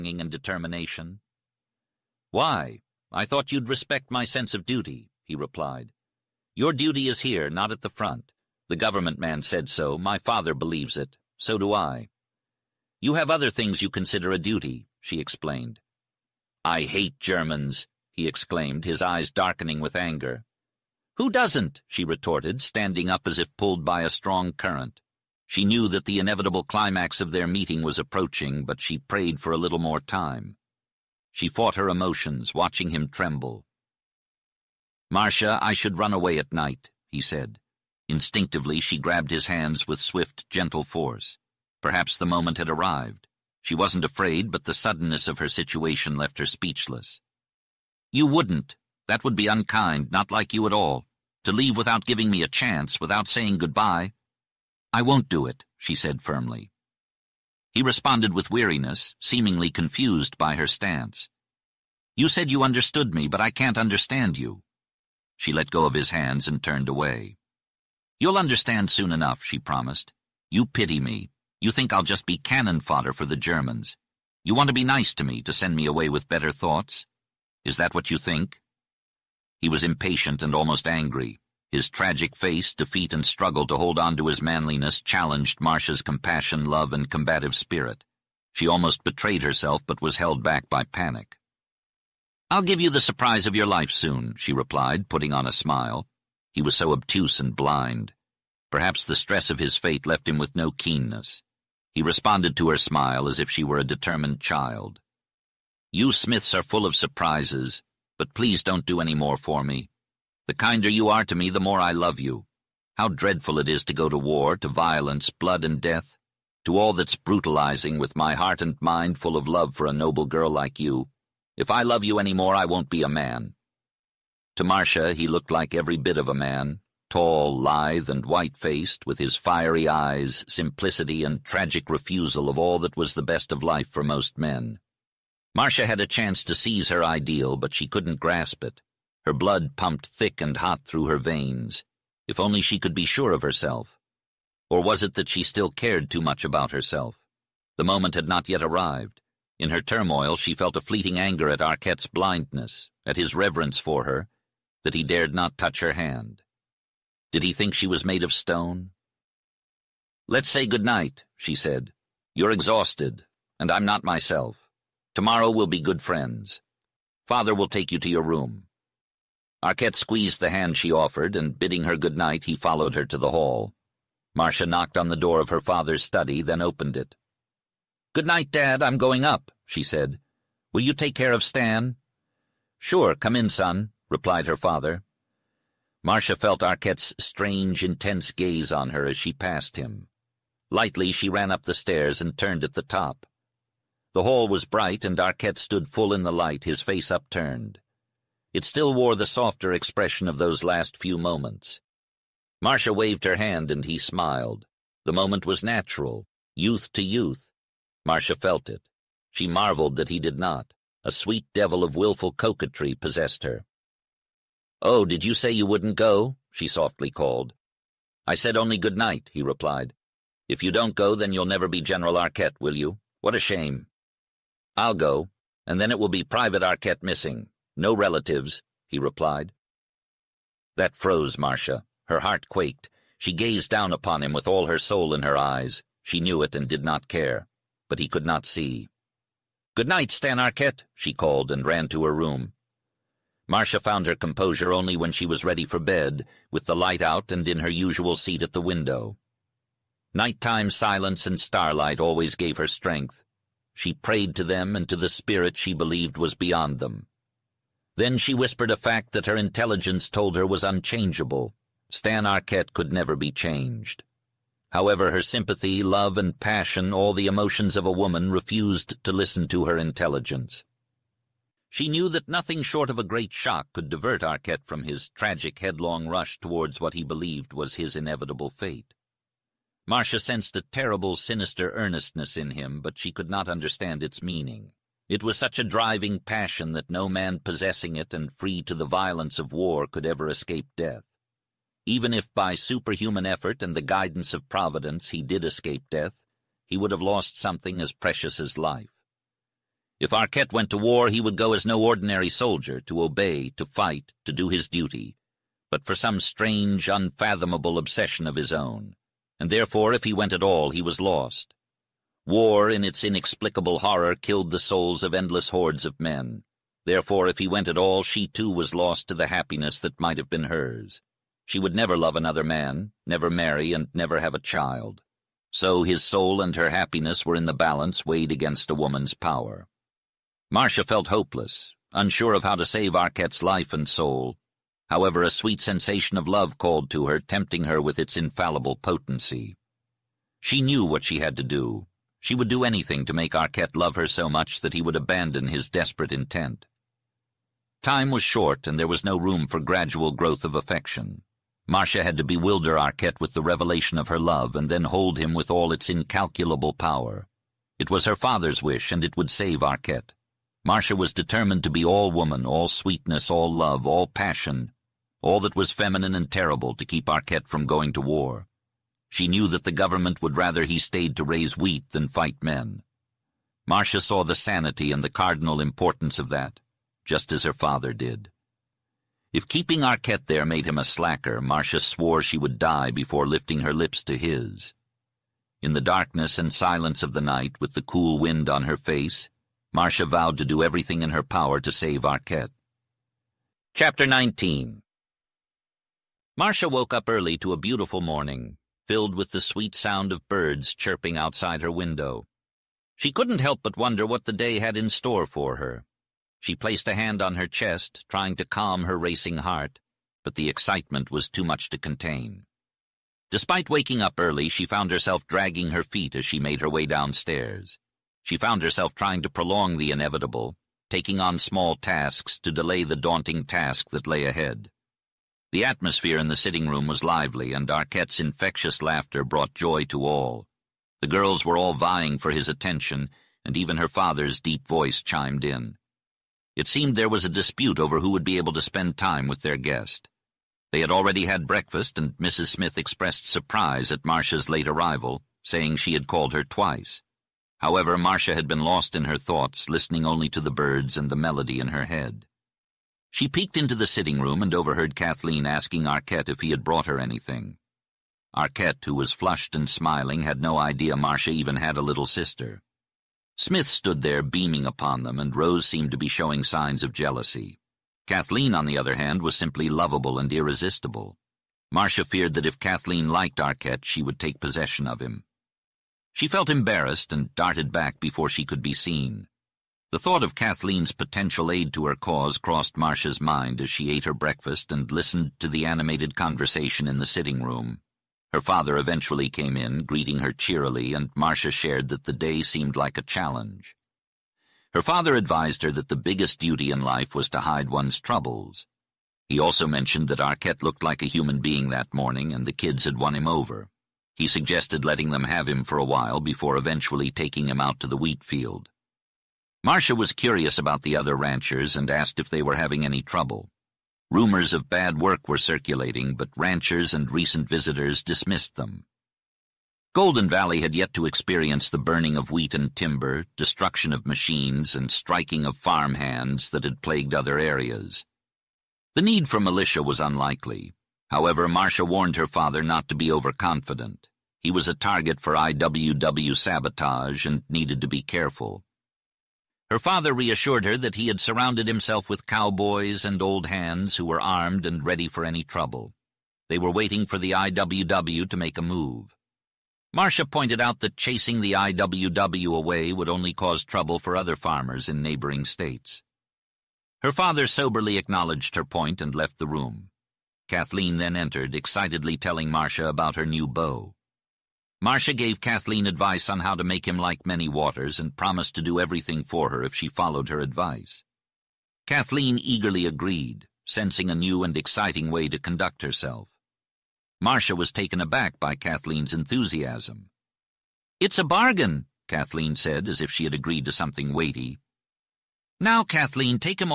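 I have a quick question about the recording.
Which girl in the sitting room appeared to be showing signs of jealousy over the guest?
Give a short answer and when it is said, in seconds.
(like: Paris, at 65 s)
Rose, at 465 s.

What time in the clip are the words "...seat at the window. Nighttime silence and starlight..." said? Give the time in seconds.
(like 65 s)
248 s.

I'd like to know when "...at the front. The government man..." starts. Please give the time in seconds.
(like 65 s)
7 s.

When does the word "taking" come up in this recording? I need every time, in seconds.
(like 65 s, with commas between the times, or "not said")
420 s, 507 s.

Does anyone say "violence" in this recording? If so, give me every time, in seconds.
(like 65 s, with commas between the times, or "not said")
114 s, 288 s.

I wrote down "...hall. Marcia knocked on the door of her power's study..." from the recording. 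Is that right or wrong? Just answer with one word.
wrong.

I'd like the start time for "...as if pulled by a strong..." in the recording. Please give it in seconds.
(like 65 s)
23 s.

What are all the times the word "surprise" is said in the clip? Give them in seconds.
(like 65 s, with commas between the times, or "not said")
93 s, 106 s, 443 s.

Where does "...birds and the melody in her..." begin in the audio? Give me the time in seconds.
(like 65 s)
450 s.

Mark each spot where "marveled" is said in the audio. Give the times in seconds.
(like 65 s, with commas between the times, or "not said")
209 s.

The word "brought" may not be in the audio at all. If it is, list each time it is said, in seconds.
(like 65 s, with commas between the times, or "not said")
429 s, 456 s.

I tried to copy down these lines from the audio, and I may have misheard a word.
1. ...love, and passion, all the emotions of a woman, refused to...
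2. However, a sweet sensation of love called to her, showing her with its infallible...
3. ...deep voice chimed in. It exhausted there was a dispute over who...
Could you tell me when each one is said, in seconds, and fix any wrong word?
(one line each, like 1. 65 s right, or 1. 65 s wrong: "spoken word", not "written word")
1. 265 s right
2. 334 s wrong: "tempting", not "showing"
3. 434 s wrong: "seemed", not "exhausted".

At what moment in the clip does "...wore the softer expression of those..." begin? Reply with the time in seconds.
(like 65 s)
198 s.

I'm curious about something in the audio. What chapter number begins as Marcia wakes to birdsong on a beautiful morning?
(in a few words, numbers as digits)
19.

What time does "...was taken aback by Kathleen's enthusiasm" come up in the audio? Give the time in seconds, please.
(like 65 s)
577 s.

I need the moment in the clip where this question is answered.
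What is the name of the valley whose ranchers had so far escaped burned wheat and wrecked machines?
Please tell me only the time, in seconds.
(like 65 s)
519 s.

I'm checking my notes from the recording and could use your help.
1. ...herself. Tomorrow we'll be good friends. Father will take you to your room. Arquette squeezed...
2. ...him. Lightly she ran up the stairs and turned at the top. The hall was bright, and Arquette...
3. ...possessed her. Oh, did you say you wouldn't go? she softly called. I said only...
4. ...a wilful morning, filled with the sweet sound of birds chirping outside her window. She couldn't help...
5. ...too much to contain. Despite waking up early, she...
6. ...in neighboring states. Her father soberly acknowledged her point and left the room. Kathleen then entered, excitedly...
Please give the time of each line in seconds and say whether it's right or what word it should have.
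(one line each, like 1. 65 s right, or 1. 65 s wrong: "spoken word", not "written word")
1. 164 s wrong: "myself", not "herself"
2. 189 s right
3. 212 s right
4. 397 s wrong: "beautiful", not "wilful"
5. 411 s right
6. 554 s right.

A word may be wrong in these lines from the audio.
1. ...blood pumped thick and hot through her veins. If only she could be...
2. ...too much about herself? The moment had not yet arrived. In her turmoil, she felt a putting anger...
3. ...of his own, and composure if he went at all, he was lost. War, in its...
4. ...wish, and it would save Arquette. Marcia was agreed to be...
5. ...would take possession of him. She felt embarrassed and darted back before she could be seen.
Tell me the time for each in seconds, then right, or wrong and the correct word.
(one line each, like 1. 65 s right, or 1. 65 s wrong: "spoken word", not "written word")
1. 139 s right
2. 146 s wrong: "fleeting", not "putting"
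3. 308 s wrong: "therefore", not "composure"
4. 358 s wrong: "determined", not "agreed"
5. 474 s right.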